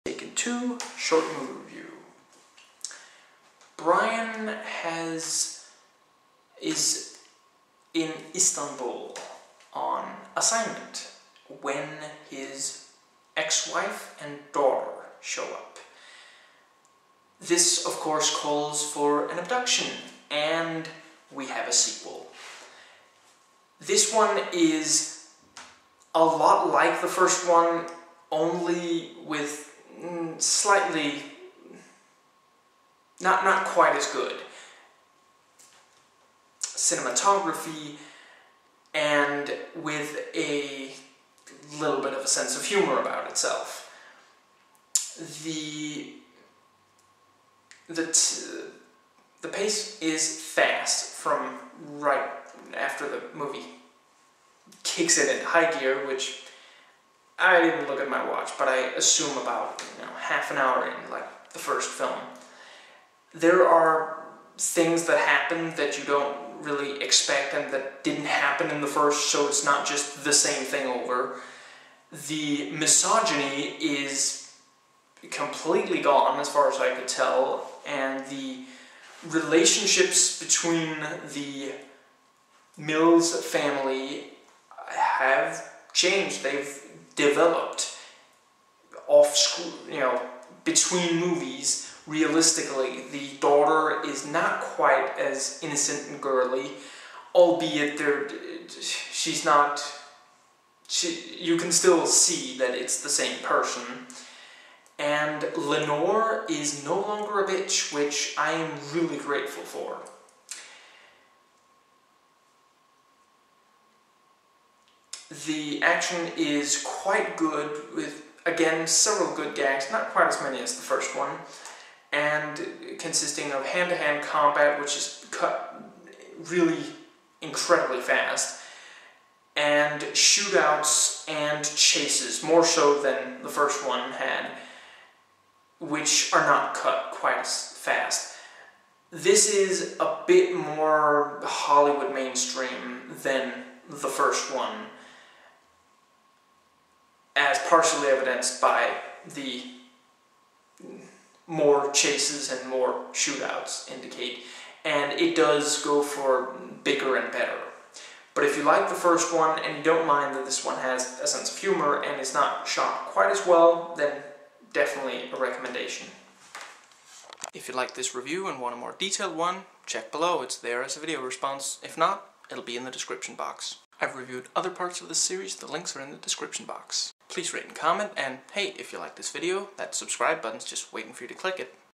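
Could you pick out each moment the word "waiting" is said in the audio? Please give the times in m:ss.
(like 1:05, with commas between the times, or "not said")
3:00.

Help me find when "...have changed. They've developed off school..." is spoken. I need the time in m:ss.
1:24.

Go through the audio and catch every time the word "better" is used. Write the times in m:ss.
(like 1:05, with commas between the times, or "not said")
2:37.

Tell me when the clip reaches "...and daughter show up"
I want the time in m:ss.
0:14.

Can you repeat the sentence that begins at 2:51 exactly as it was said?
If not, it'll be in the description box.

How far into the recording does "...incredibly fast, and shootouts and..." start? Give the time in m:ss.
2:07.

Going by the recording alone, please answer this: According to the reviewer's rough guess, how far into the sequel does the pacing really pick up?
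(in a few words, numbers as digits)
half an hour.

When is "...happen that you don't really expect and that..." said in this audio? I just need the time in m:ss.
1:05.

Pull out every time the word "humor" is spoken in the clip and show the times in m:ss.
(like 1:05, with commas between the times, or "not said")
0:42, 2:41.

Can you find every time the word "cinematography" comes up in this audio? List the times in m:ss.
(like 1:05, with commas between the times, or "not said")
0:36.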